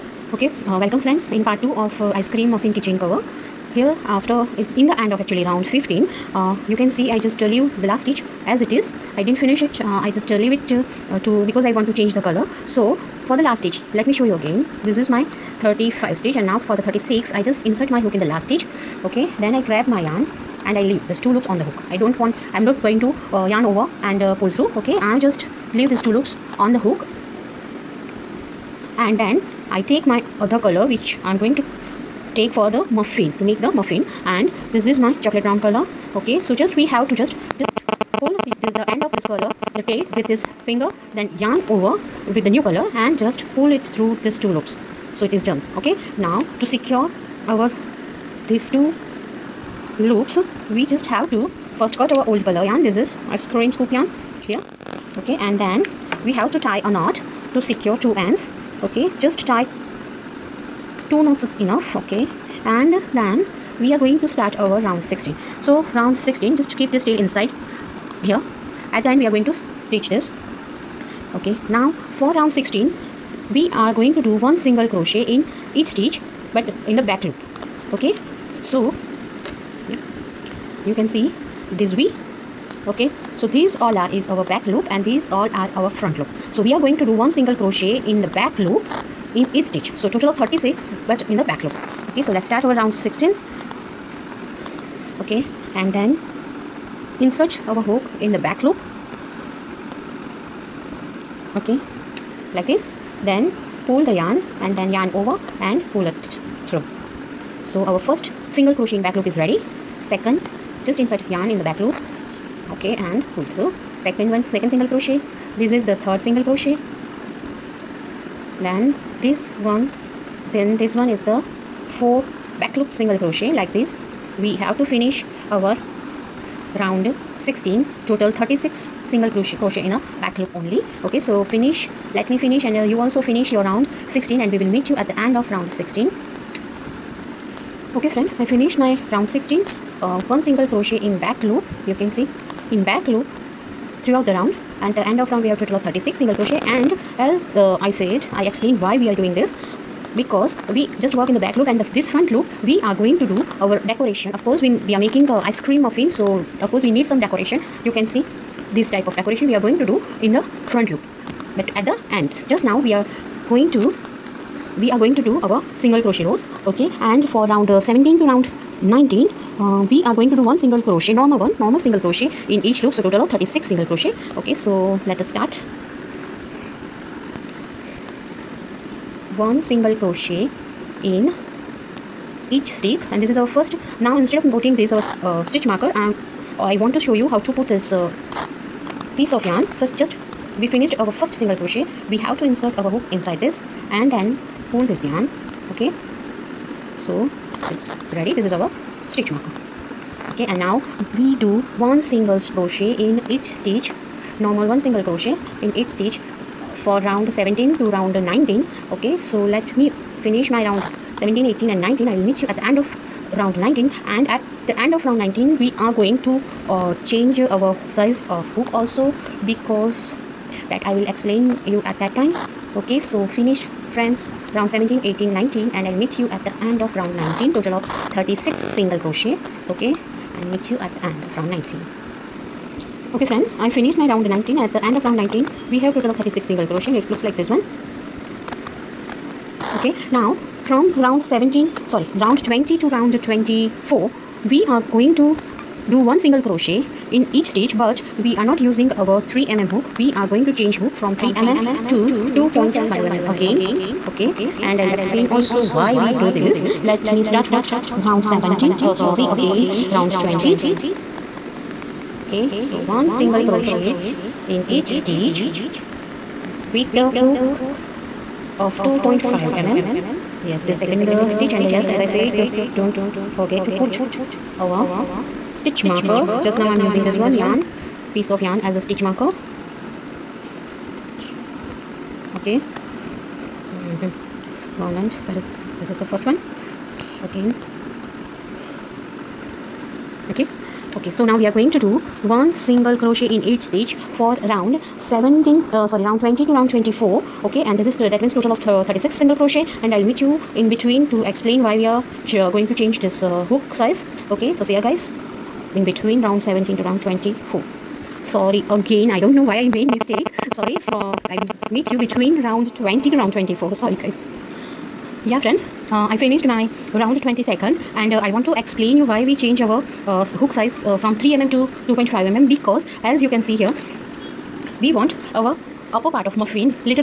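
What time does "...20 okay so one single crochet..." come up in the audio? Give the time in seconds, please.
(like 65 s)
260 s.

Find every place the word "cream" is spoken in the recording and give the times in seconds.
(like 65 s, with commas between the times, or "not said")
2 s, 53 s, 155 s.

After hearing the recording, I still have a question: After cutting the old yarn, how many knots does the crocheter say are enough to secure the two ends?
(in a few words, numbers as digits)
2.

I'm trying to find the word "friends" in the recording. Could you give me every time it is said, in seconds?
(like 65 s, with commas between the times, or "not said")
1 s, 138 s, 223 s, 233 s, 315 s.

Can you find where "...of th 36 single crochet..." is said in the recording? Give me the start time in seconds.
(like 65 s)
298 s.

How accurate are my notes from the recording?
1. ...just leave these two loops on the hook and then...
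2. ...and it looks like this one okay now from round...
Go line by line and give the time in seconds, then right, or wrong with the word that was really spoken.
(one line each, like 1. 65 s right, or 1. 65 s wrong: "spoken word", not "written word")
1. 25 s right
2. 236 s right.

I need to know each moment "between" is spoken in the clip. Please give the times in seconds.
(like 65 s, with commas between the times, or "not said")
300 s, 305 s, 312 s.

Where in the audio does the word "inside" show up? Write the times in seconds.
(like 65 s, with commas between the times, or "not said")
67 s, 193 s.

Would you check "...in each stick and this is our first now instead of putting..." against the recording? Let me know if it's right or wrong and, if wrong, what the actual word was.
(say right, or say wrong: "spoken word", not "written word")
right.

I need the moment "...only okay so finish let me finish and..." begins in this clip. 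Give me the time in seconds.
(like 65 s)
130 s.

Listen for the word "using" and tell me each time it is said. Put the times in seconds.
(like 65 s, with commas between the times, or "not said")
248 s, 276 s.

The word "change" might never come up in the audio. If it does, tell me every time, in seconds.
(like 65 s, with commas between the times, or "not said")
11 s, 217 s, 250 s, 302 s, 319 s.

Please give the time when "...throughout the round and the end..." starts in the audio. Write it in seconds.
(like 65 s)
144 s.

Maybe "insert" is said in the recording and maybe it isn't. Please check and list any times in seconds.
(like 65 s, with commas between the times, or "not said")
17 s, 97 s, 111 s, 192 s.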